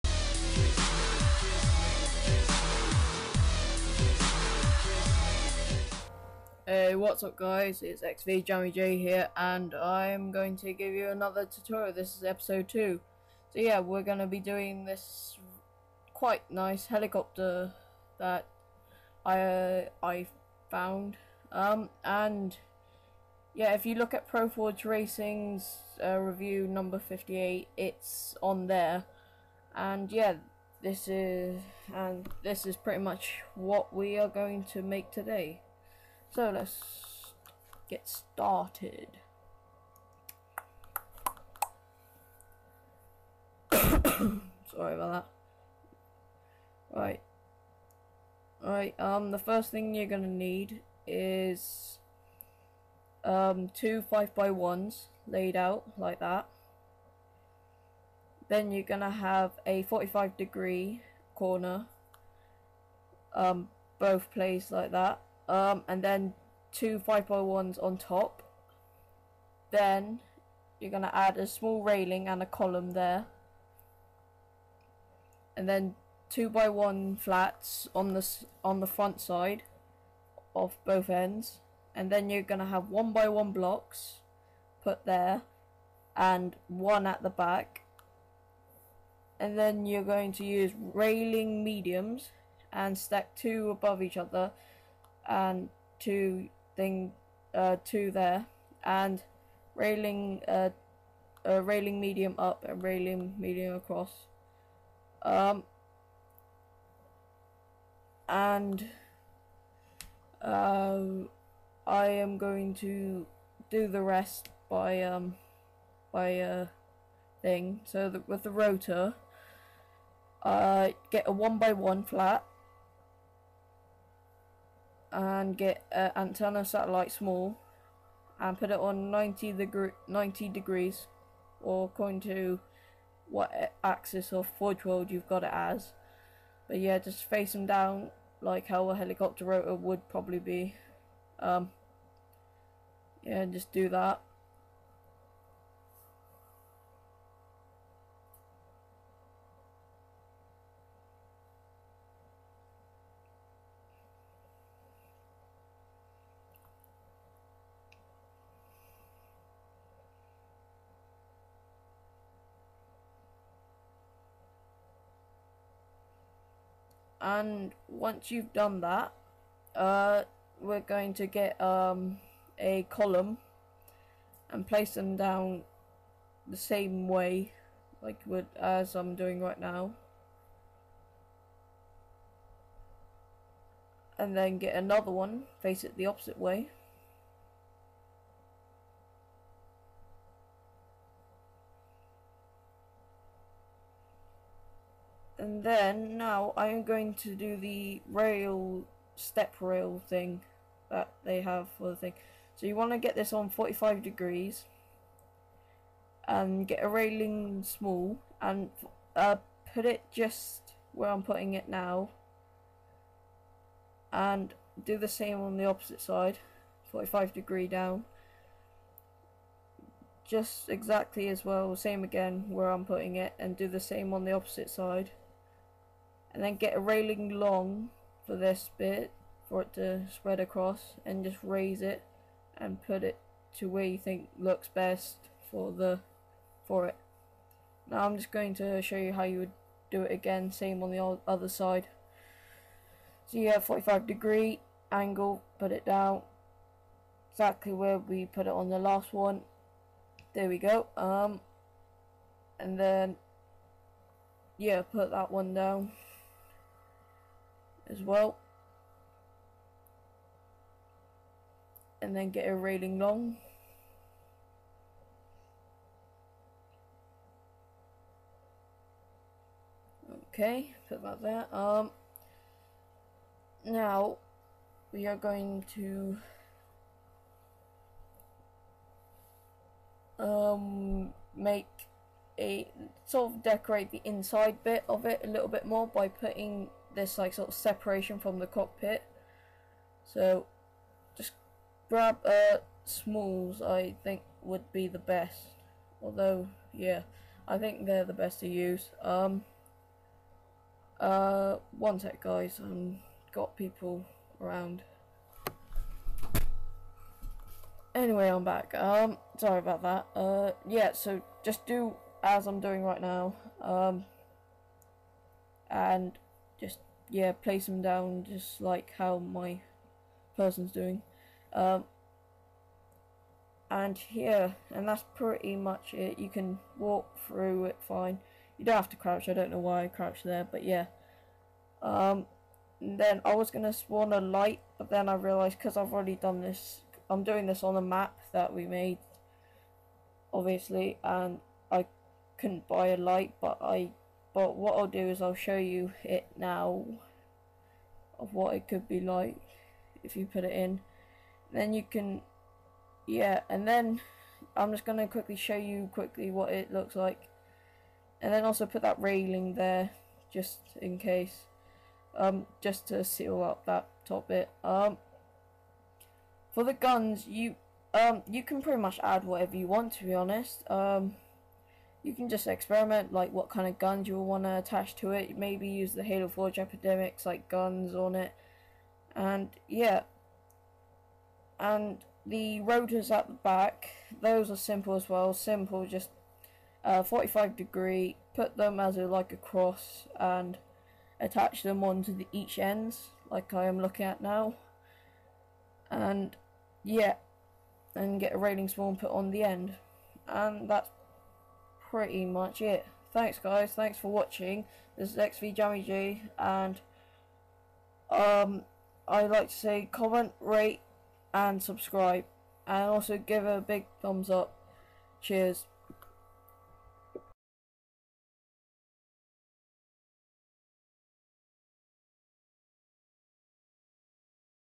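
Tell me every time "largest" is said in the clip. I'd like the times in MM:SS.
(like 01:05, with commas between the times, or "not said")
not said.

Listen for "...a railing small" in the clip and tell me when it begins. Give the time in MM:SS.
03:26.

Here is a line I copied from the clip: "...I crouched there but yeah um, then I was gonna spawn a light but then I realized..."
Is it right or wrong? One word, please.
right.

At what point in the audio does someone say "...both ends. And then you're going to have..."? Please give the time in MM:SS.
01:20.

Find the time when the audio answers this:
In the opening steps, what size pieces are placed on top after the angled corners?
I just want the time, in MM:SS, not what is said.
01:06.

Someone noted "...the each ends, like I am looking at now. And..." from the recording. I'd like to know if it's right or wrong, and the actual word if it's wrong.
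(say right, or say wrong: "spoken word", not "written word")
right.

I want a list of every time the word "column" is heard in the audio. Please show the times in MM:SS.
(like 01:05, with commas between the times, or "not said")
01:12, 02:52.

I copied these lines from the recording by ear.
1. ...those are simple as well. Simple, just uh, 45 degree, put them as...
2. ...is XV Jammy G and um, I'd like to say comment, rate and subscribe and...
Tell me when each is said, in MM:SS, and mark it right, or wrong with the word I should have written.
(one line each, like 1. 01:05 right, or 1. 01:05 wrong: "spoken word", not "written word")
1. 06:24 right
2. 06:45 right.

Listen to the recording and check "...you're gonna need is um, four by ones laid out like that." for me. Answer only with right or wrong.
wrong.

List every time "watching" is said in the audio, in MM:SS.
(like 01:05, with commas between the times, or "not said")
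06:44.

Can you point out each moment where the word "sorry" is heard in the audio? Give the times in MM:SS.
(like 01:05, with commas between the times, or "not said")
00:43, 05:09.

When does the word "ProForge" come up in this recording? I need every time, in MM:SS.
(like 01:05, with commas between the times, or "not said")
00:24.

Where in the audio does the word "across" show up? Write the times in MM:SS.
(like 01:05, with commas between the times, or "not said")
01:43, 03:50.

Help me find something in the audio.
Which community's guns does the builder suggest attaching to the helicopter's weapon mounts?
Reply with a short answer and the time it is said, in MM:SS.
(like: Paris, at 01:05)
Halo Forge Epidemics, at 06:16.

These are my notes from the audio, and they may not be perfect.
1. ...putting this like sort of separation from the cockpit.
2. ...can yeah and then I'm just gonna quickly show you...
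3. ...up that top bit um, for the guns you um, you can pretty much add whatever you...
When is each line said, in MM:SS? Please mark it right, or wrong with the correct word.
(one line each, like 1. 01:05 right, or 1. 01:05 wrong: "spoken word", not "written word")
1. 04:46 right
2. 05:51 right
3. 06:03 right.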